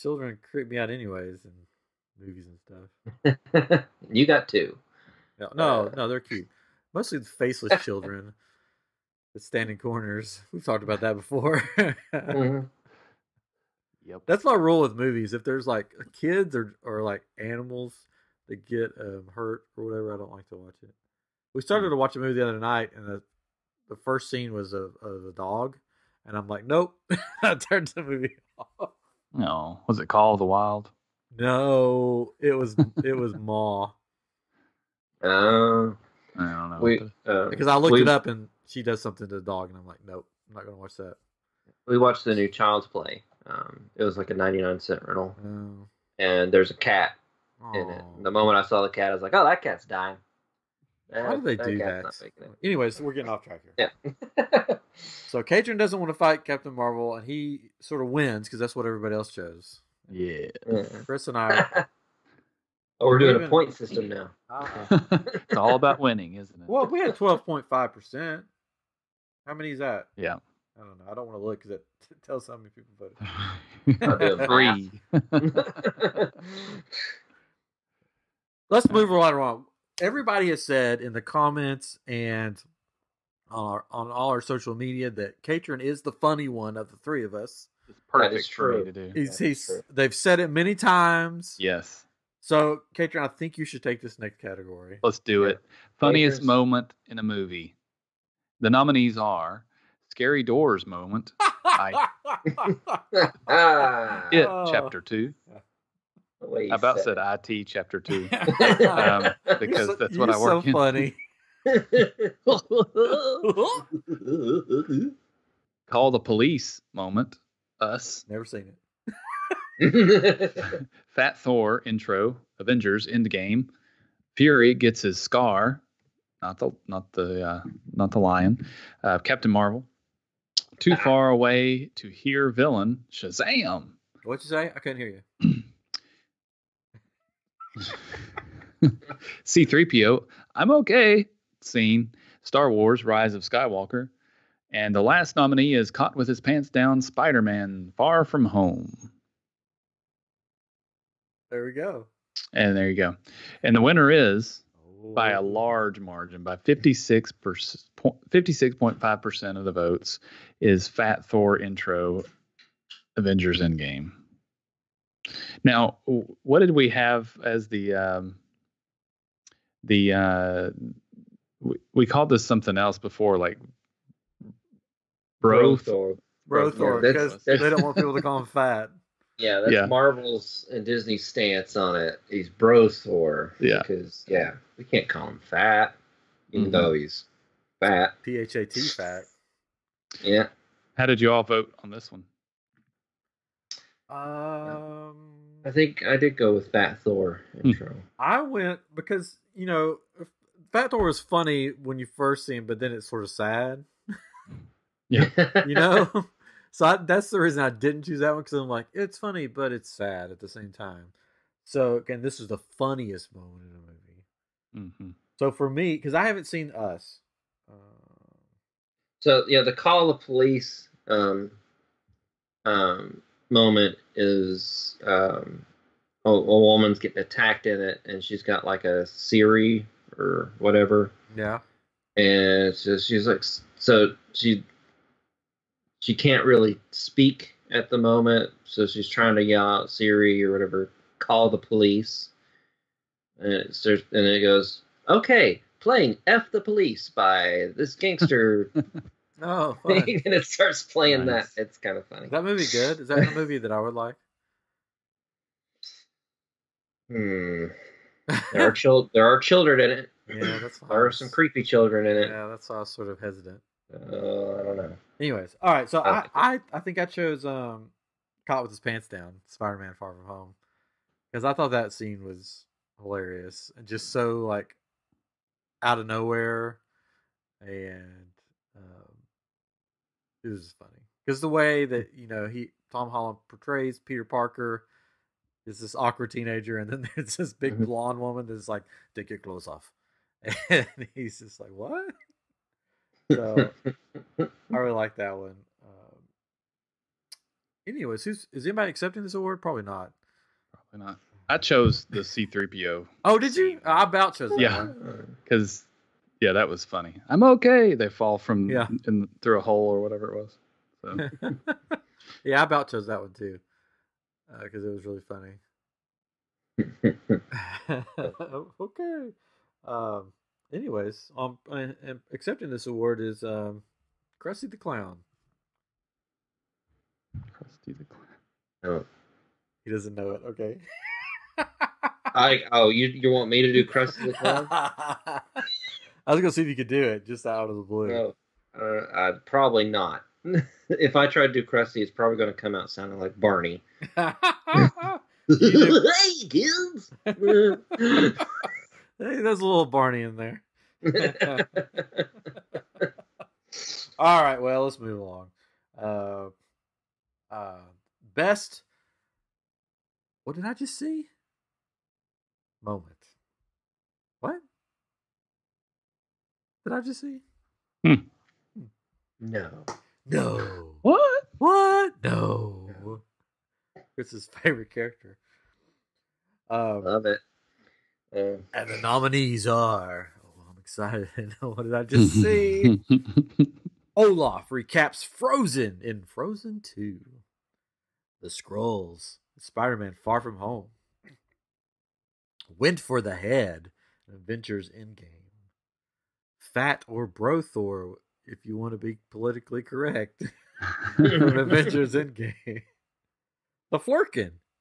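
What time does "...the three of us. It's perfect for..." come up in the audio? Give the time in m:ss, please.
1:26.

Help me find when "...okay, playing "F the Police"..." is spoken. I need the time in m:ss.
4:05.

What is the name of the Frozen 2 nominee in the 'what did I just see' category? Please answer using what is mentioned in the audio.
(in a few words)
Olaf recaps Frozen.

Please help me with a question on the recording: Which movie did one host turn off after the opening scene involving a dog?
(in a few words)
Ma.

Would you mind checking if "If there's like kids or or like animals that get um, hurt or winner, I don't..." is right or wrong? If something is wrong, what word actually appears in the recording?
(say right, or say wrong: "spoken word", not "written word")
wrong: "whatever", not "winner".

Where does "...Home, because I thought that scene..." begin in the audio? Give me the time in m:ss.
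4:30.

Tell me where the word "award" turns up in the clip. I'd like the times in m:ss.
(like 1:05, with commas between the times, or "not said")
4:59, 5:22.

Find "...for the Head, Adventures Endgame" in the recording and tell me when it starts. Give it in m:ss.
6:32.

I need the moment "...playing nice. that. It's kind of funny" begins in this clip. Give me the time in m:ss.
4:10.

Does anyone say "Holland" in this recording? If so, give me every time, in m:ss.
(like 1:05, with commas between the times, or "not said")
4:43.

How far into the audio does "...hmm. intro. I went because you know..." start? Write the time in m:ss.
3:17.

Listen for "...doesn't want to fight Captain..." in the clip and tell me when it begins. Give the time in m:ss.
0:55.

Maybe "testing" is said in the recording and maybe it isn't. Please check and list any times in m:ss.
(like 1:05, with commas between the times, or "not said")
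not said.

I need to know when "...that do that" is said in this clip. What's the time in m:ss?
0:51.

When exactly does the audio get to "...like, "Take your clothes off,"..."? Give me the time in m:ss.
4:48.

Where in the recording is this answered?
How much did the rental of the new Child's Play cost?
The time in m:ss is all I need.
0:44.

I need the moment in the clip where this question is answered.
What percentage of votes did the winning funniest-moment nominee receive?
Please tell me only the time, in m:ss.
2:37.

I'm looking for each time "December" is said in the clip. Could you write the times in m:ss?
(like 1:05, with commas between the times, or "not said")
not said.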